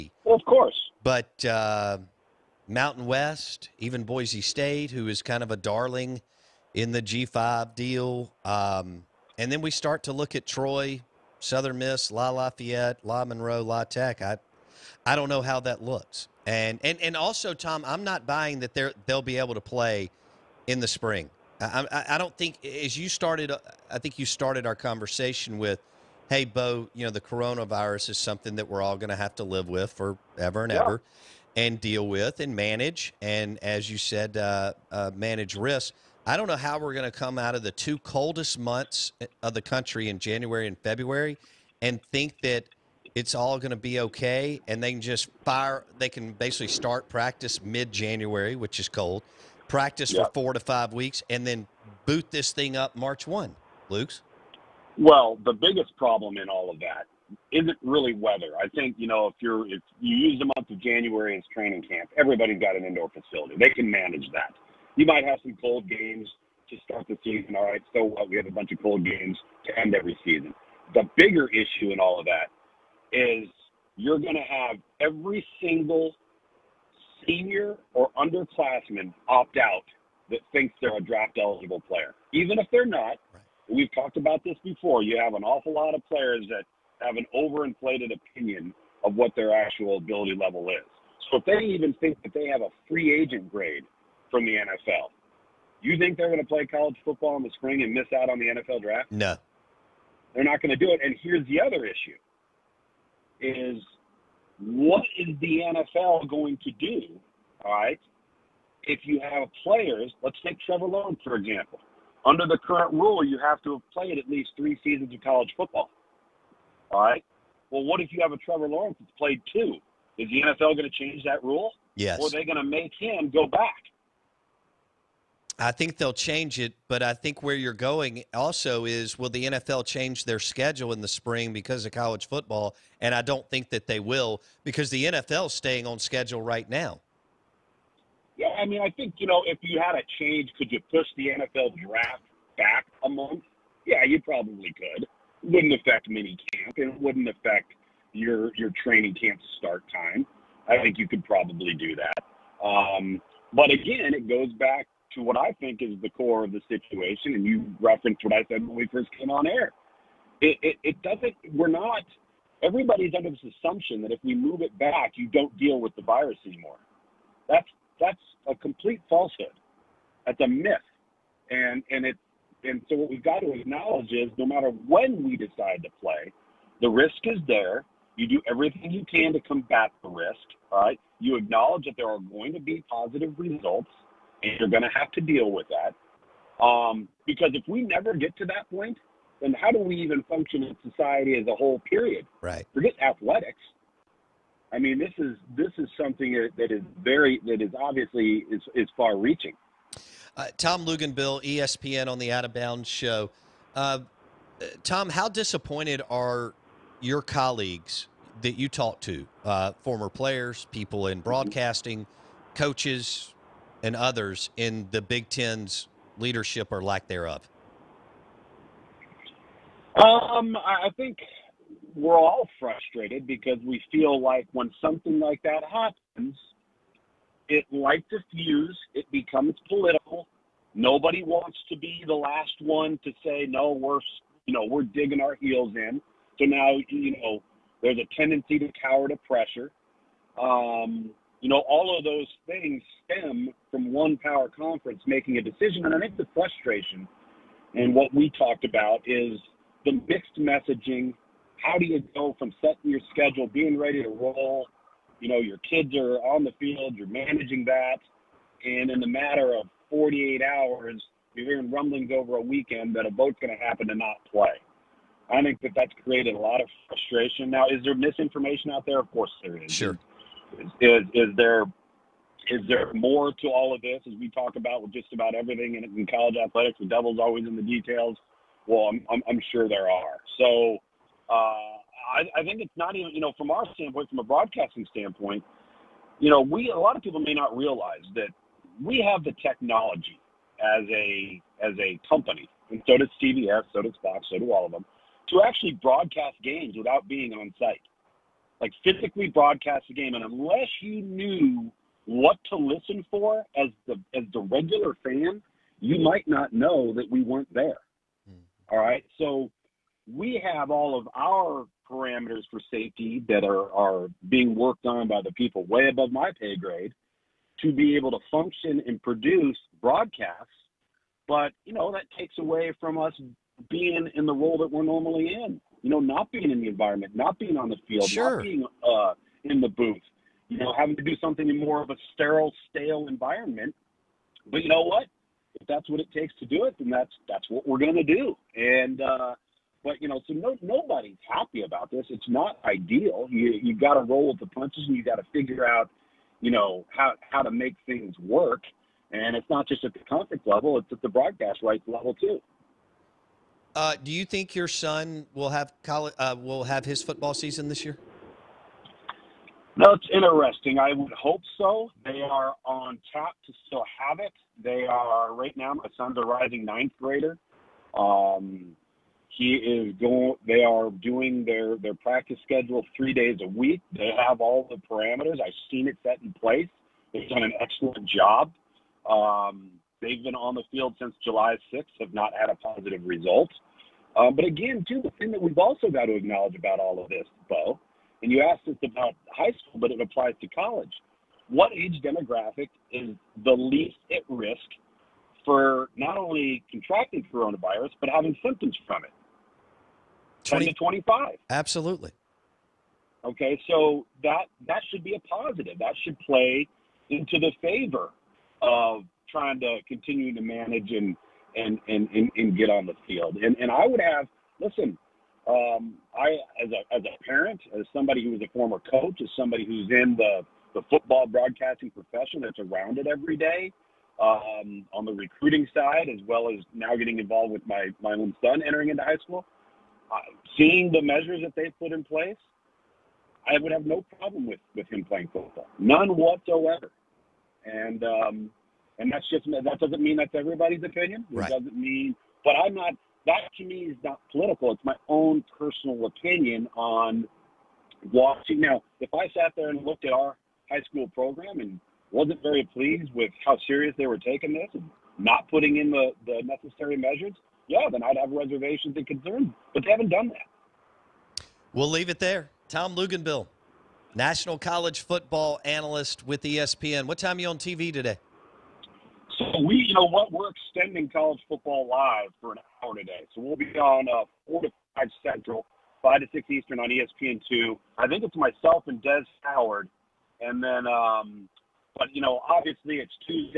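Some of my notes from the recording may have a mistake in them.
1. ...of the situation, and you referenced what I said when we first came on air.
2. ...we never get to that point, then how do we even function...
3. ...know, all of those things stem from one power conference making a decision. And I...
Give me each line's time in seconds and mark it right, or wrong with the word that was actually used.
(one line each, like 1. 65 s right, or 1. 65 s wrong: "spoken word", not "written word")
1. 156 s right
2. 187 s right
3. 241 s right.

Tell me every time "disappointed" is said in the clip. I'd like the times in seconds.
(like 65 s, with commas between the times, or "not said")
205 s.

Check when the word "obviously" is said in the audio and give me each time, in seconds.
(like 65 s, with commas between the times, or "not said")
197 s, 482 s.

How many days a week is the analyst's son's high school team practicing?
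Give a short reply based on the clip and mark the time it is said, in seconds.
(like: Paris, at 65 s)
3, at 372 s.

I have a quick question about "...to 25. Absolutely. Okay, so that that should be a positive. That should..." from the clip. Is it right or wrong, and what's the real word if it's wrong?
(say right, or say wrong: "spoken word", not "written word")
right.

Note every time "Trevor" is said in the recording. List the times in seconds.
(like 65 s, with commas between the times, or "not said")
110 s, 118 s.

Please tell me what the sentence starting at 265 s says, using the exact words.
I think that that's created a lot of frustration.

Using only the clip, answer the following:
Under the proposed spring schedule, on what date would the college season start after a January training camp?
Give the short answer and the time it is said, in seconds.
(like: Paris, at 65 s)
March 1, at 52 s.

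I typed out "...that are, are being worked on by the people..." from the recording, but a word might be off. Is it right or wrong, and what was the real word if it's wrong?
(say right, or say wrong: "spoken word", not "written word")
right.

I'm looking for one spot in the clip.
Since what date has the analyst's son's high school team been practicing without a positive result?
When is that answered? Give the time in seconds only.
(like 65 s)
381 s.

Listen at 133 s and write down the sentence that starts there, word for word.
And I don't think that they will because the NFL's staying on schedule right now.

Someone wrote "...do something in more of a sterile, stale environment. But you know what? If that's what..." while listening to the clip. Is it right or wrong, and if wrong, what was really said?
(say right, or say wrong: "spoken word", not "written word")
right.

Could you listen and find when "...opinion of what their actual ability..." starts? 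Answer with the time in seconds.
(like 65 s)
88 s.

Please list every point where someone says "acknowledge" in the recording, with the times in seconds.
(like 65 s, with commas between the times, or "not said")
173 s, 181 s, 386 s.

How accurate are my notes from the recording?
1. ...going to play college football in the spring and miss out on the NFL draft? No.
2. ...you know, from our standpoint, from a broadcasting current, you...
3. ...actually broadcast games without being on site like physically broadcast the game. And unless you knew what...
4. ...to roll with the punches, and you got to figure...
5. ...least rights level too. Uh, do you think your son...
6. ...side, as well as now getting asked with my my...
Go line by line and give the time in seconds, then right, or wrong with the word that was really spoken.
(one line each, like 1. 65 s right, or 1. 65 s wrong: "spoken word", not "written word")
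1. 96 s right
2. 283 s wrong: "standpoint", not "current"
3. 295 s right
4. 343 s right
5. 351 s wrong: "broadcast", not "least"
6. 425 s wrong: "involved", not "asked".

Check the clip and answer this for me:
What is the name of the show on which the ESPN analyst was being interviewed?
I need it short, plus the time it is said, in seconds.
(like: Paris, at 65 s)
Out of Bounds, at 202 s.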